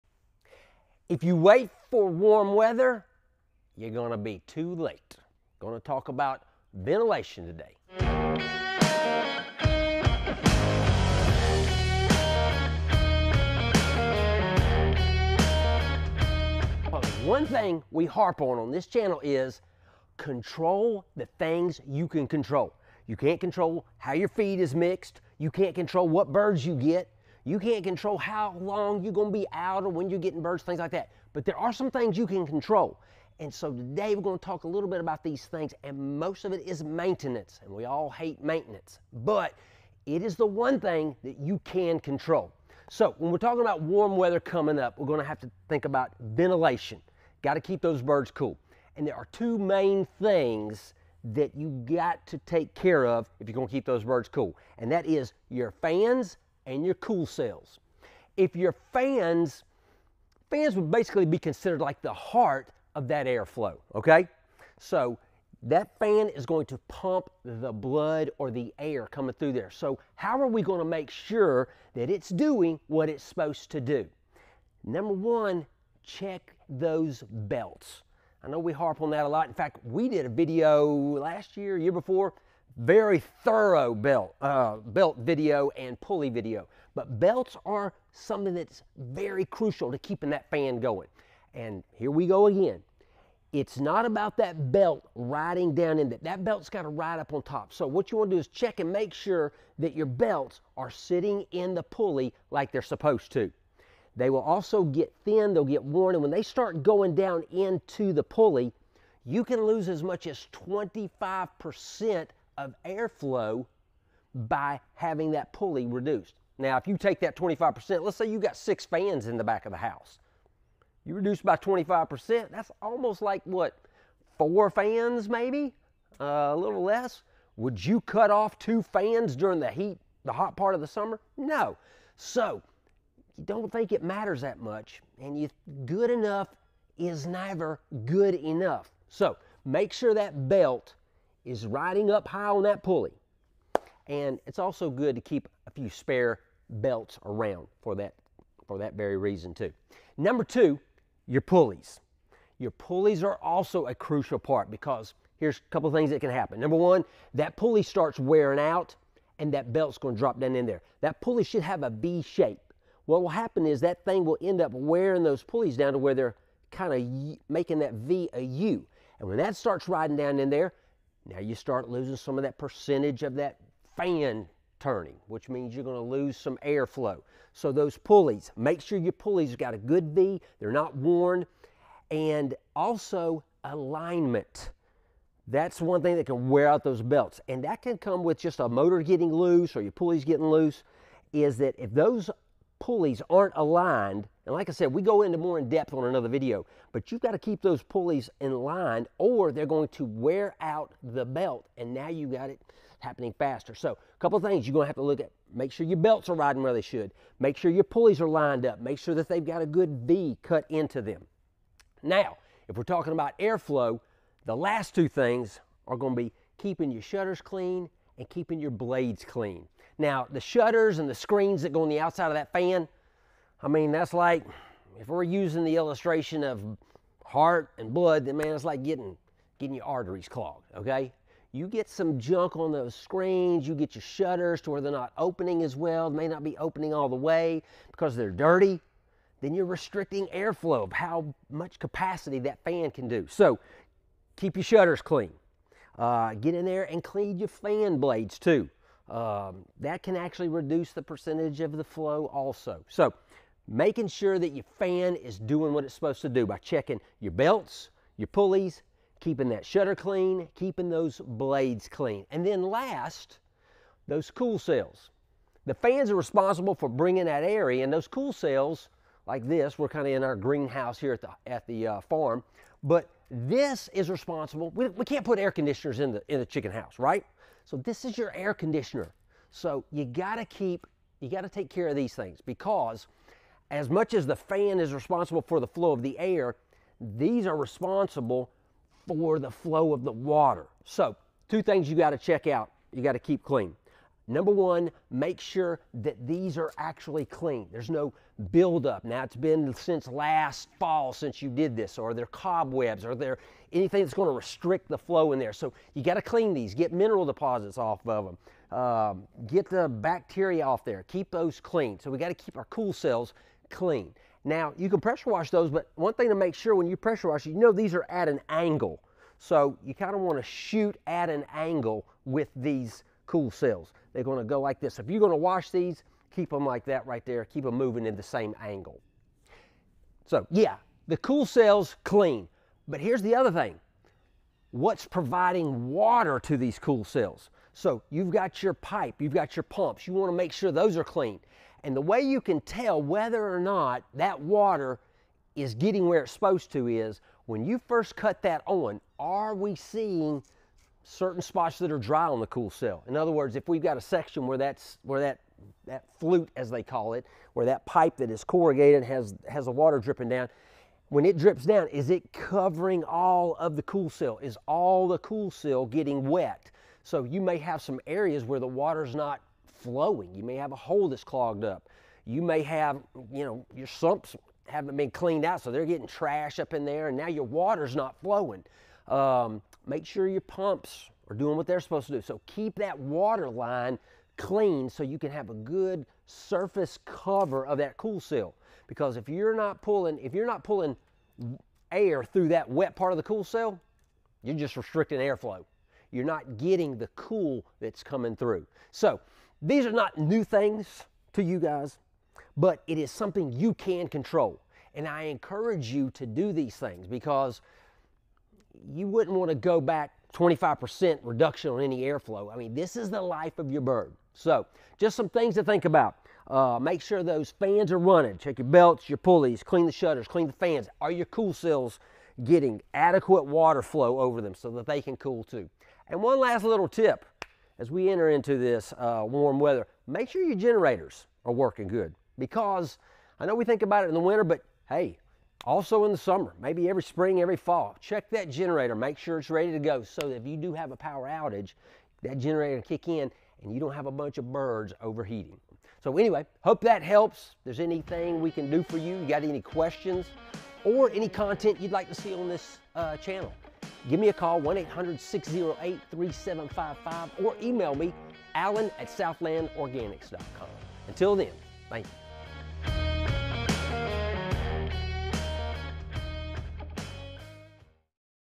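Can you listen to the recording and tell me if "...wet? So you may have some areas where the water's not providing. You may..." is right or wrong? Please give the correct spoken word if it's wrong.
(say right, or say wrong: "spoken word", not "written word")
wrong: "flowing", not "providing".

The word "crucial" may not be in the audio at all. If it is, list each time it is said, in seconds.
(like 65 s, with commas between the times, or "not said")
89 s, 153 s.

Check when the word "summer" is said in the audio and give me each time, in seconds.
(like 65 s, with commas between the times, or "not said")
130 s, 436 s.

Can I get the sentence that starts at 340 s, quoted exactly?
You wanna make sure those are clean.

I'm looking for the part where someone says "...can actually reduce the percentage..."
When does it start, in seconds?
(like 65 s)
250 s.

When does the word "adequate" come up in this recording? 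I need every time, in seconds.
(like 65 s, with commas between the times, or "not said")
422 s.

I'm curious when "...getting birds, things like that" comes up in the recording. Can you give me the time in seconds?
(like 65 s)
30 s.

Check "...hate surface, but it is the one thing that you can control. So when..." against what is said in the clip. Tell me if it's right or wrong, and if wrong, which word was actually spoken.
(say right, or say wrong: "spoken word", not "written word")
wrong: "maintenance", not "surface".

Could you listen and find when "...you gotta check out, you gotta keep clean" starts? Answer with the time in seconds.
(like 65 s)
291 s.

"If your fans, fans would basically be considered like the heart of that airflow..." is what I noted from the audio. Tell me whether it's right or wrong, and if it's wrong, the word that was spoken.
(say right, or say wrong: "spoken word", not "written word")
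right.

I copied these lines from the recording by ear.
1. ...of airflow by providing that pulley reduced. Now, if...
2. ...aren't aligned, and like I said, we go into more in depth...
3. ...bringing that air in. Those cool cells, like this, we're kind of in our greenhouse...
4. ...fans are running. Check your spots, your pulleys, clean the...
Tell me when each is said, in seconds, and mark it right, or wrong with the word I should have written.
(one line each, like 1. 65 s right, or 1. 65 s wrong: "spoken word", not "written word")
1. 112 s wrong: "having", not "providing"
2. 193 s right
3. 266 s right
4. 417 s wrong: "belts", not "spots".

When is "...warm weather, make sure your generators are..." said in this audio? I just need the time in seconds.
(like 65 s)
429 s.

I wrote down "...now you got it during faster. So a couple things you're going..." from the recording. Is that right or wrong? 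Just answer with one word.
wrong.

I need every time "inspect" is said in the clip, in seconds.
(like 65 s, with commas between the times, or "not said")
not said.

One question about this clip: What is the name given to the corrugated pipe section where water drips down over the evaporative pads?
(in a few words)
Flute.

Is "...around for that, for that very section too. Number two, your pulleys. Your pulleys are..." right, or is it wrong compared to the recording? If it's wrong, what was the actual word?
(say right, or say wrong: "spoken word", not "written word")
wrong: "reason", not "section".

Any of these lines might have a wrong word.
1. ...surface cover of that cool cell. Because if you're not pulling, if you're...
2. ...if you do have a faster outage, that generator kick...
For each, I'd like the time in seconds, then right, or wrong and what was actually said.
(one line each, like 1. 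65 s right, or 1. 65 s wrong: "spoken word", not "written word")
1. 386 s right
2. 440 s wrong: "power", not "faster".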